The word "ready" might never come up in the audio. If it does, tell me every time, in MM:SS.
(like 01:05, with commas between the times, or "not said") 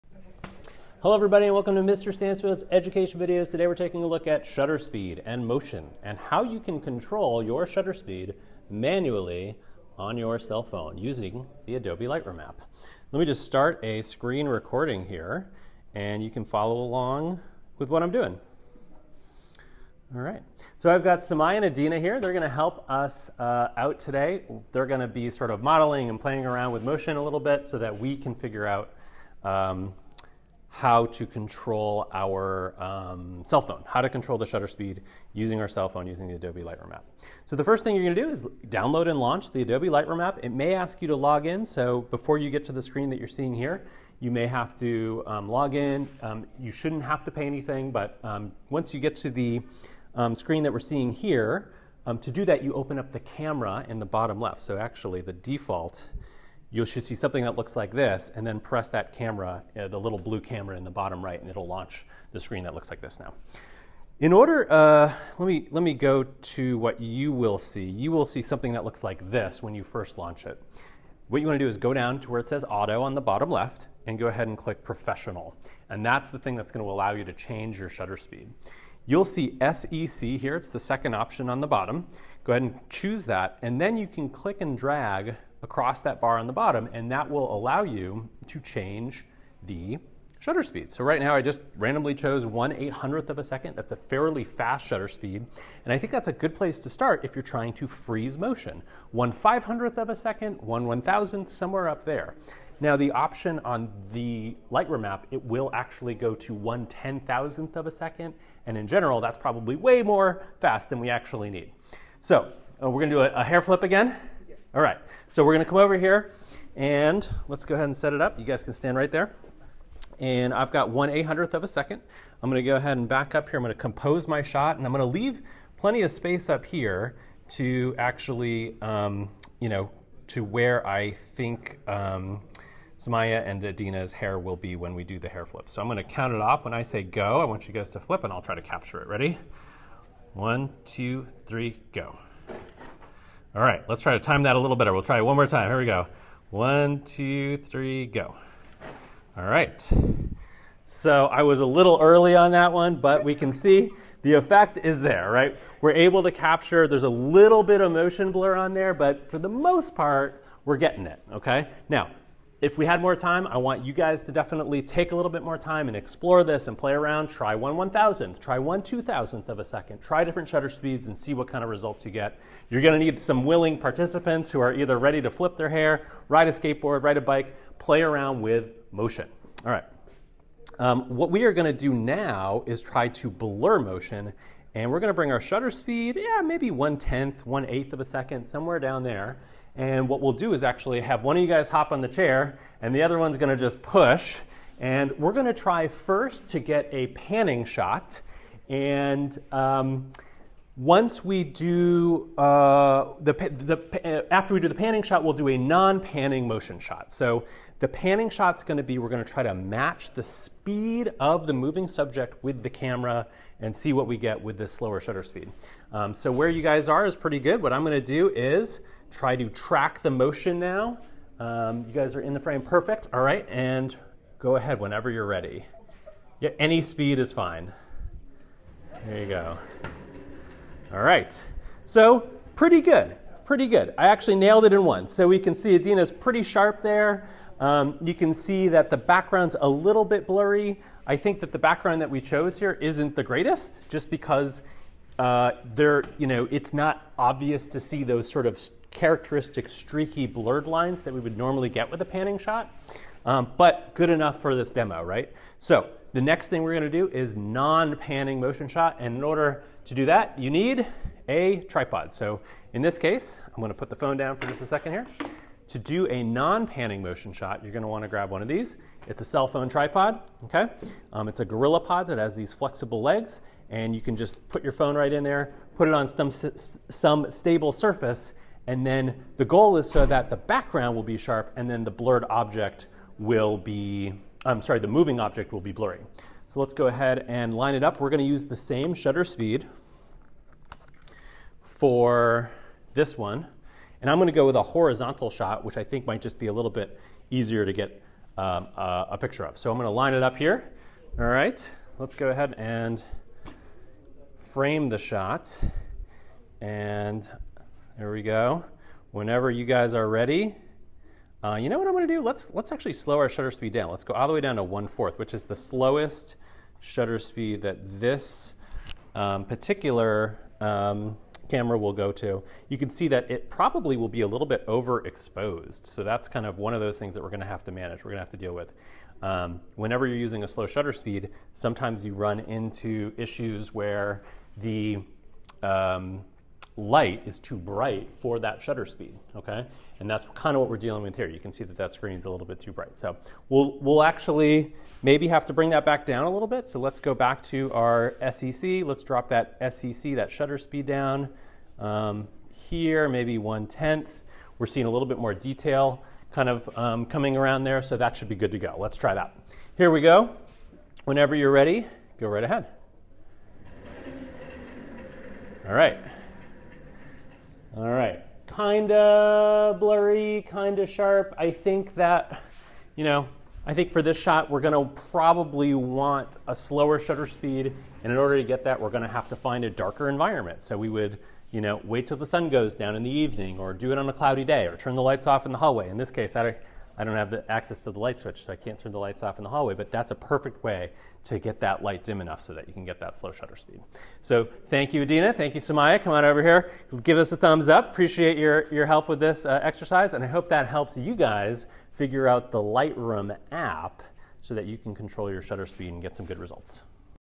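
02:19, 02:54, 03:45, 05:10, 06:01.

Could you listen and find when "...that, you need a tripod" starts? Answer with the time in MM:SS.
04:20.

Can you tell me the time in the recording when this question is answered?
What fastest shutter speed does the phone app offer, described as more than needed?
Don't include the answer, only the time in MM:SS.
01:46.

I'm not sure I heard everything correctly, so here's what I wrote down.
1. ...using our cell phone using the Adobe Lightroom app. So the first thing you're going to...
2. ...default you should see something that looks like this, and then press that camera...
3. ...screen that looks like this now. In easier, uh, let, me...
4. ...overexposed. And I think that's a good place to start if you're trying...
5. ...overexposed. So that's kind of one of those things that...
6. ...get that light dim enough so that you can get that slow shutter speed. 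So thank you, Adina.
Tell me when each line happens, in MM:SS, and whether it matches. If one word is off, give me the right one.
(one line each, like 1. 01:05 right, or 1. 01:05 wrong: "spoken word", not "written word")
1. 00:35 right
2. 00:55 right
3. 01:02 wrong: "order", not "easier"
4. 01:35 wrong: "speed", not "overexposed"
5. 05:24 right
6. 06:31 right.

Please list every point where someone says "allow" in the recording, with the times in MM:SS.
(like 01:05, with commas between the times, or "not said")
01:16, 01:27.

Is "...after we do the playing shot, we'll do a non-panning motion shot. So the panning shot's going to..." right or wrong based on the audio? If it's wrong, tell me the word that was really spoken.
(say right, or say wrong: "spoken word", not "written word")
wrong: "panning", not "playing".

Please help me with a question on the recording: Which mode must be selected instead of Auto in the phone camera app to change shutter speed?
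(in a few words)
Professional.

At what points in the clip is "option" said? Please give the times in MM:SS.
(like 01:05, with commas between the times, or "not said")
01:21, 01:43.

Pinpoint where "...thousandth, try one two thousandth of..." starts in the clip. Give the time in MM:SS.
02:47.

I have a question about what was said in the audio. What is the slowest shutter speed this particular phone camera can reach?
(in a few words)
1/4.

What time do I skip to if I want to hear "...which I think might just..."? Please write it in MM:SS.
04:55.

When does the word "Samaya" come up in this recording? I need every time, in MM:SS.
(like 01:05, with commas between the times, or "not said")
00:21, 02:12, 06:35.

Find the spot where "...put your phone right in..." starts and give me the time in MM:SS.
04:34.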